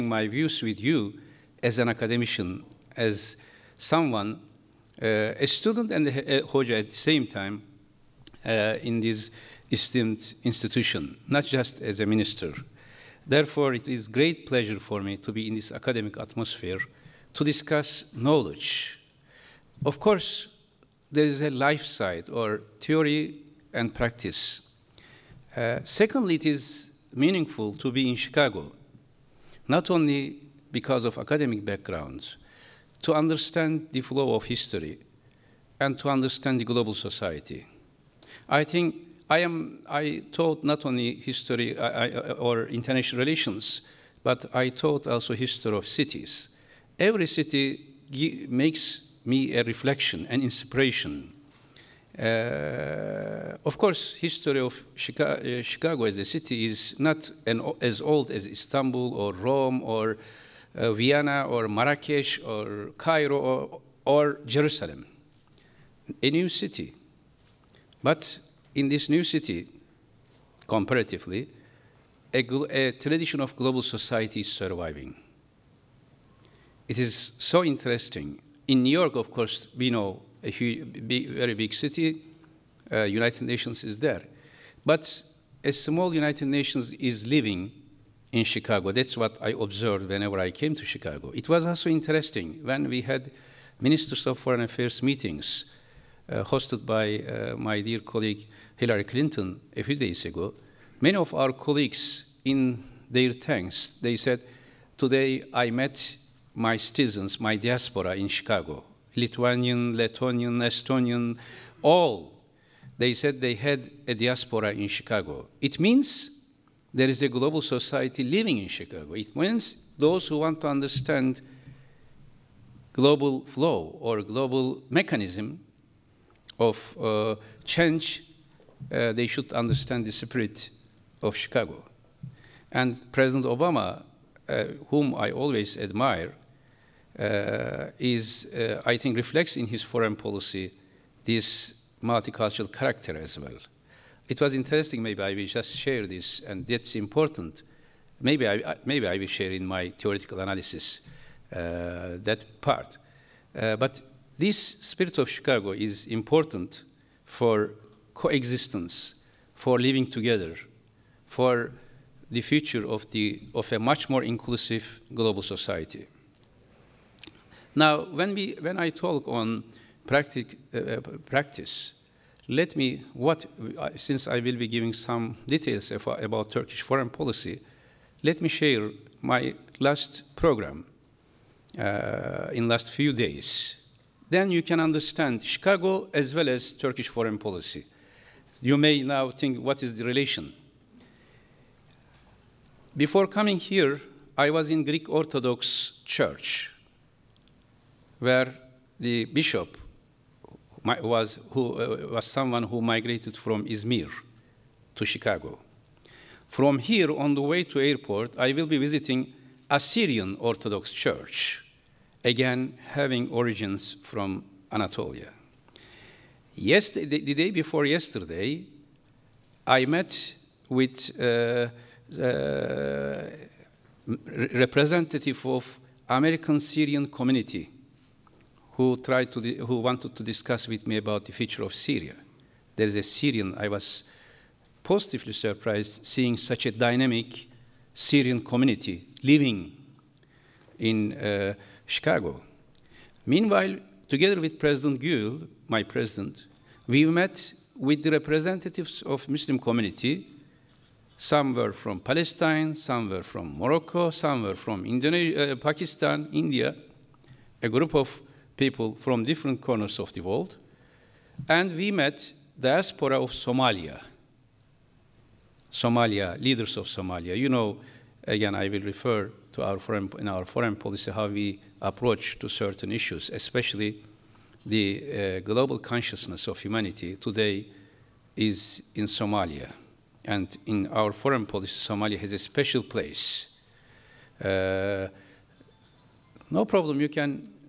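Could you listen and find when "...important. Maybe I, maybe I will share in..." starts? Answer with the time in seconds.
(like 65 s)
146 s.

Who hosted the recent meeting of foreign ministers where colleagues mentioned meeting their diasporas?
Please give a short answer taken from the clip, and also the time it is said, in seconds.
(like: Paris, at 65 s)
Hillary Clinton, at 98 s.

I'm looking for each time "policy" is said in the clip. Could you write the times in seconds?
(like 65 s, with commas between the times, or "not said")
140 s, 177 s, 187 s, 270 s, 281 s.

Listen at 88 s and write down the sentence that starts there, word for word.
That's what I observed whenever I came to Chicago.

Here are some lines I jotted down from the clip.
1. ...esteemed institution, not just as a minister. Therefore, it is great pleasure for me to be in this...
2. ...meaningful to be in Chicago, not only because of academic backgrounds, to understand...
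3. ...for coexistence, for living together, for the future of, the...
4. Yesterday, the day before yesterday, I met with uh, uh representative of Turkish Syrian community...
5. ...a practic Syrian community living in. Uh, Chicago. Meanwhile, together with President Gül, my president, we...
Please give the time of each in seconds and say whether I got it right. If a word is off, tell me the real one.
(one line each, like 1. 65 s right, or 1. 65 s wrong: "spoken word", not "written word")
1. 9 s right
2. 27 s right
3. 157 s right
4. 216 s wrong: "American", not "Turkish"
5. 236 s wrong: "dynamic", not "practic".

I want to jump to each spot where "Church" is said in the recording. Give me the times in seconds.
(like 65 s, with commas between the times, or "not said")
196 s, 210 s.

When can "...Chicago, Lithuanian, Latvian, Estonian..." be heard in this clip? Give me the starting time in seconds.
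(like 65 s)
108 s.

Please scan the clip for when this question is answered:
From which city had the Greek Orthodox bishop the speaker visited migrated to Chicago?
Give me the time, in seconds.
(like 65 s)
203 s.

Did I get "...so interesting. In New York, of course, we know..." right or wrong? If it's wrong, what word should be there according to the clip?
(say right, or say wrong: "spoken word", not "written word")
right.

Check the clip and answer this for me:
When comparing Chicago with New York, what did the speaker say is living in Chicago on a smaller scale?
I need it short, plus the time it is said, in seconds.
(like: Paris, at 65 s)
A small United Nations, at 85 s.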